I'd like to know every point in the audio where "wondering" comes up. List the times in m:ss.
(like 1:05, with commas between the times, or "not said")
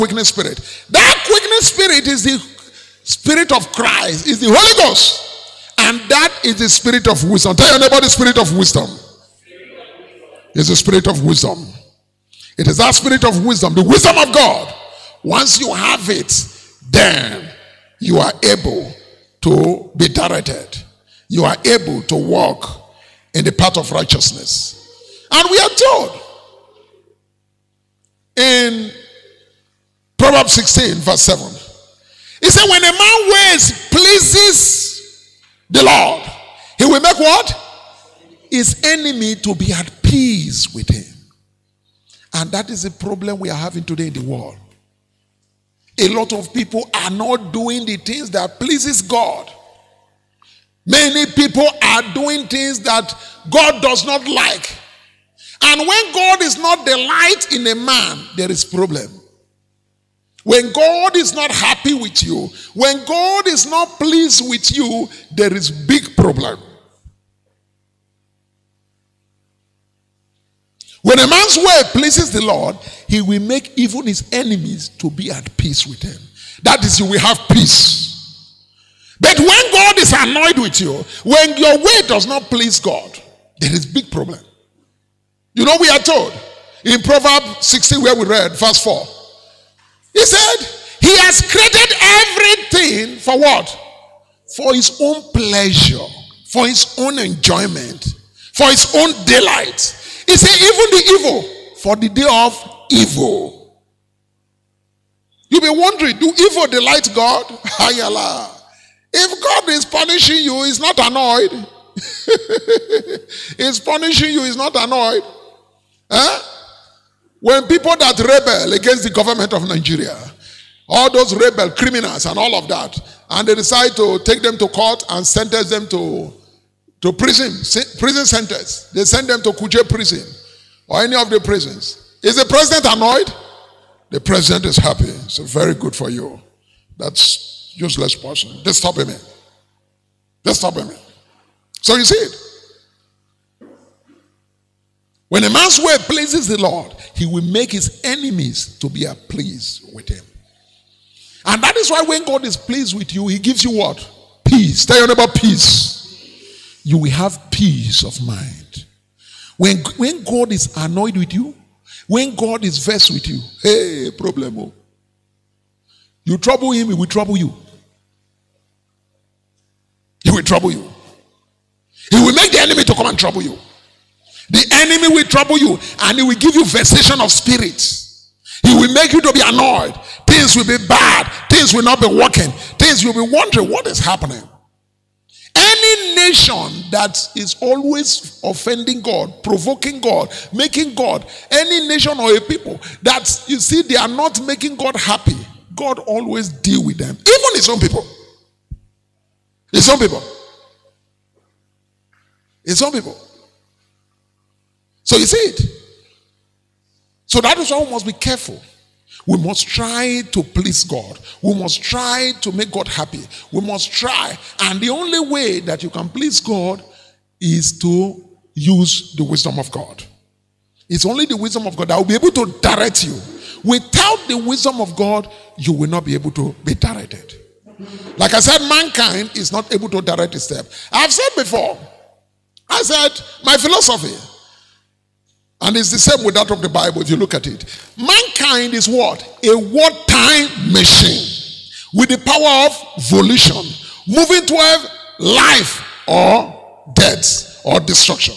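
1:45, 3:03.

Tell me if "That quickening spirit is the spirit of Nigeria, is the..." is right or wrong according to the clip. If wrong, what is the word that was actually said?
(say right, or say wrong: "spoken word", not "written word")
wrong: "Christ", not "Nigeria".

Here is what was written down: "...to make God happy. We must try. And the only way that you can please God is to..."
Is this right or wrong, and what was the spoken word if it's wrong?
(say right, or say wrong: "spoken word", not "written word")
right.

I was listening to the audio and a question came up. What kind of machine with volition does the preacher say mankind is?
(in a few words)
A wartime machine.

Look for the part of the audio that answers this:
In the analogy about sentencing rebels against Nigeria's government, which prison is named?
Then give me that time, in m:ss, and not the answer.
2:09.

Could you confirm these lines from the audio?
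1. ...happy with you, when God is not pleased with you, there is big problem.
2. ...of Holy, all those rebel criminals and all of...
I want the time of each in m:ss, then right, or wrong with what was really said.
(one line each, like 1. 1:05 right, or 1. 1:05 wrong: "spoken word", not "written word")
1. 1:01 right
2. 1:59 wrong: "Nigeria", not "Holy".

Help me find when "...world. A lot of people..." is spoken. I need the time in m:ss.
0:44.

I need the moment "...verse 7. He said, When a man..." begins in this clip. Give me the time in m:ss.
0:30.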